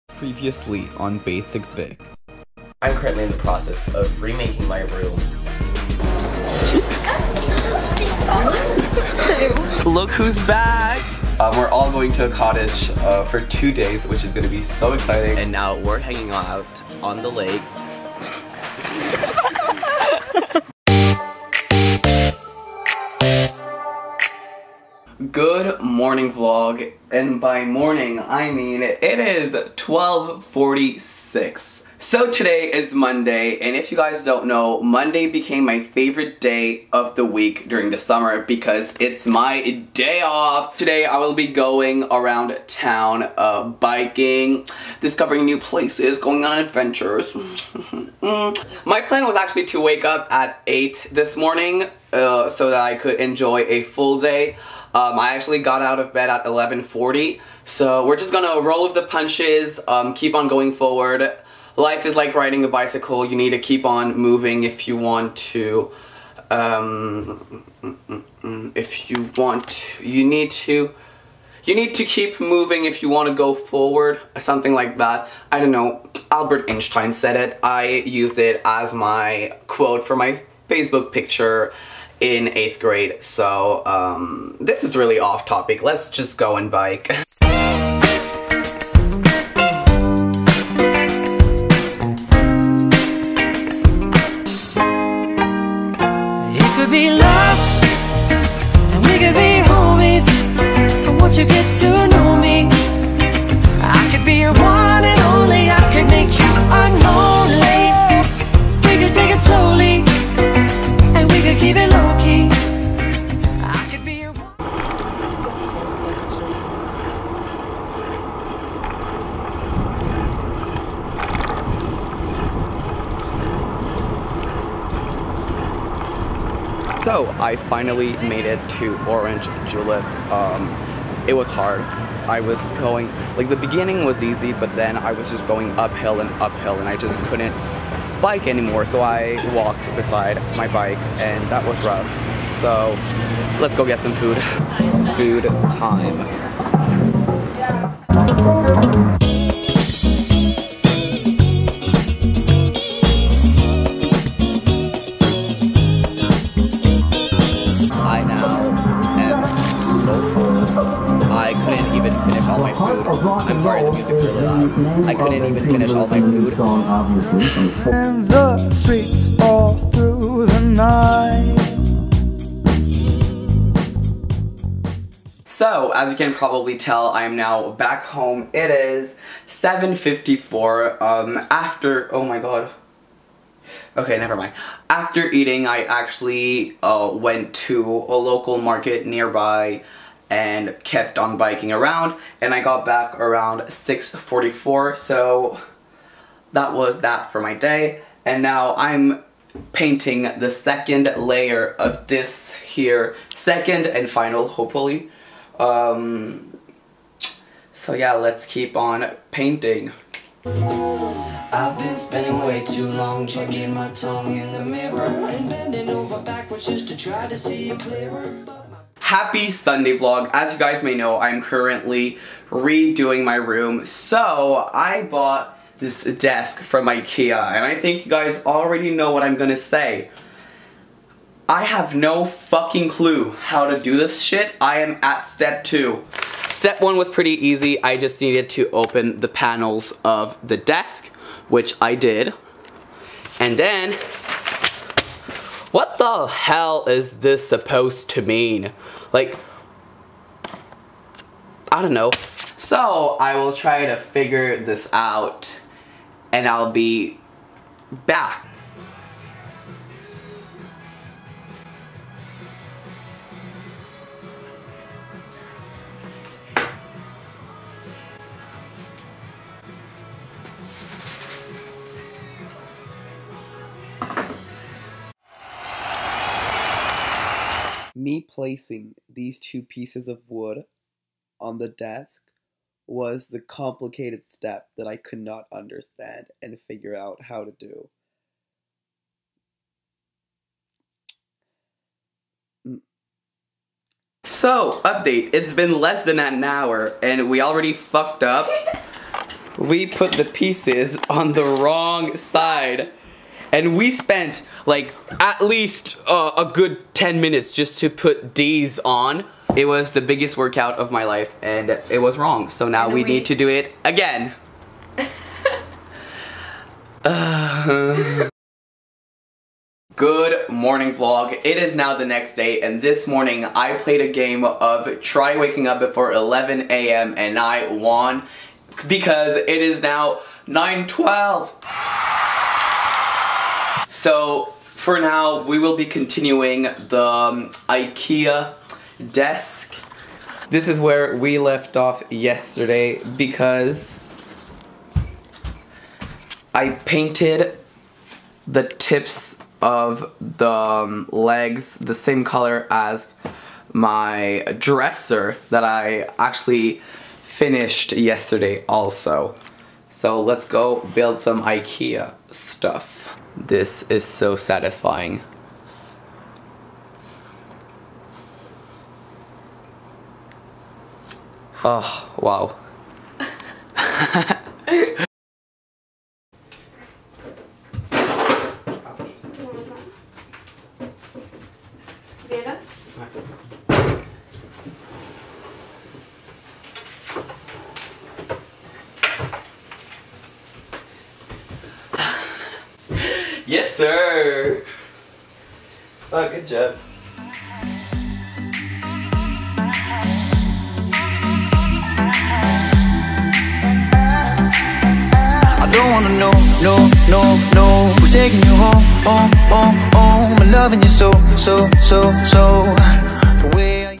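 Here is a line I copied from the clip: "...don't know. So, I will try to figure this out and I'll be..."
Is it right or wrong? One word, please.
right.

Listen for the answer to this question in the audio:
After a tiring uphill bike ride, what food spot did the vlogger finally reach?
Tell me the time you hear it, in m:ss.
2:09.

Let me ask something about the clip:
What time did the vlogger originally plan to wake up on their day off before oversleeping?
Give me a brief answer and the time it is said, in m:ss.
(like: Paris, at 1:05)
8, at 0:50.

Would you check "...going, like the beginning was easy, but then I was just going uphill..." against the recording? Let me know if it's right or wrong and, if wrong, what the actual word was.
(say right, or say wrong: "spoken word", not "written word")
right.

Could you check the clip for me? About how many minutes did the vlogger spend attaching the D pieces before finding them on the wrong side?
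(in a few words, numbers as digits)
10.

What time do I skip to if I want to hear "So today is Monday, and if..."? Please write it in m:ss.
0:32.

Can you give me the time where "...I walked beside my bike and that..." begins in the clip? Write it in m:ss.
2:19.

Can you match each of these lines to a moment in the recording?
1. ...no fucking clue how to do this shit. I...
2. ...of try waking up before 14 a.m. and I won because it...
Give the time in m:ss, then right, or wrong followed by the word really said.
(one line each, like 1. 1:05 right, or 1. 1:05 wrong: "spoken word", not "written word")
1. 3:51 right
2. 5:24 wrong: "11", not "14".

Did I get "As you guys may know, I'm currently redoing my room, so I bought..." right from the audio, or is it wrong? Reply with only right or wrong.
right.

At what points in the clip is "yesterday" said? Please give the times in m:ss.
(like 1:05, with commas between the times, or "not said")
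5:42, 5:57.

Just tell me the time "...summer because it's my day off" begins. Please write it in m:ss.
0:37.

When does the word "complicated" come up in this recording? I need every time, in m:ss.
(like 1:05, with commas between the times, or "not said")
4:43.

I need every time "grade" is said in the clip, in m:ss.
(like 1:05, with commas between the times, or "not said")
1:22.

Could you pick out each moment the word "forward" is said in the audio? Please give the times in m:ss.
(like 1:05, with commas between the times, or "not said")
1:00, 1:13.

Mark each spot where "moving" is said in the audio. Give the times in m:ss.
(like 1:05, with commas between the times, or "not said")
1:04, 1:12.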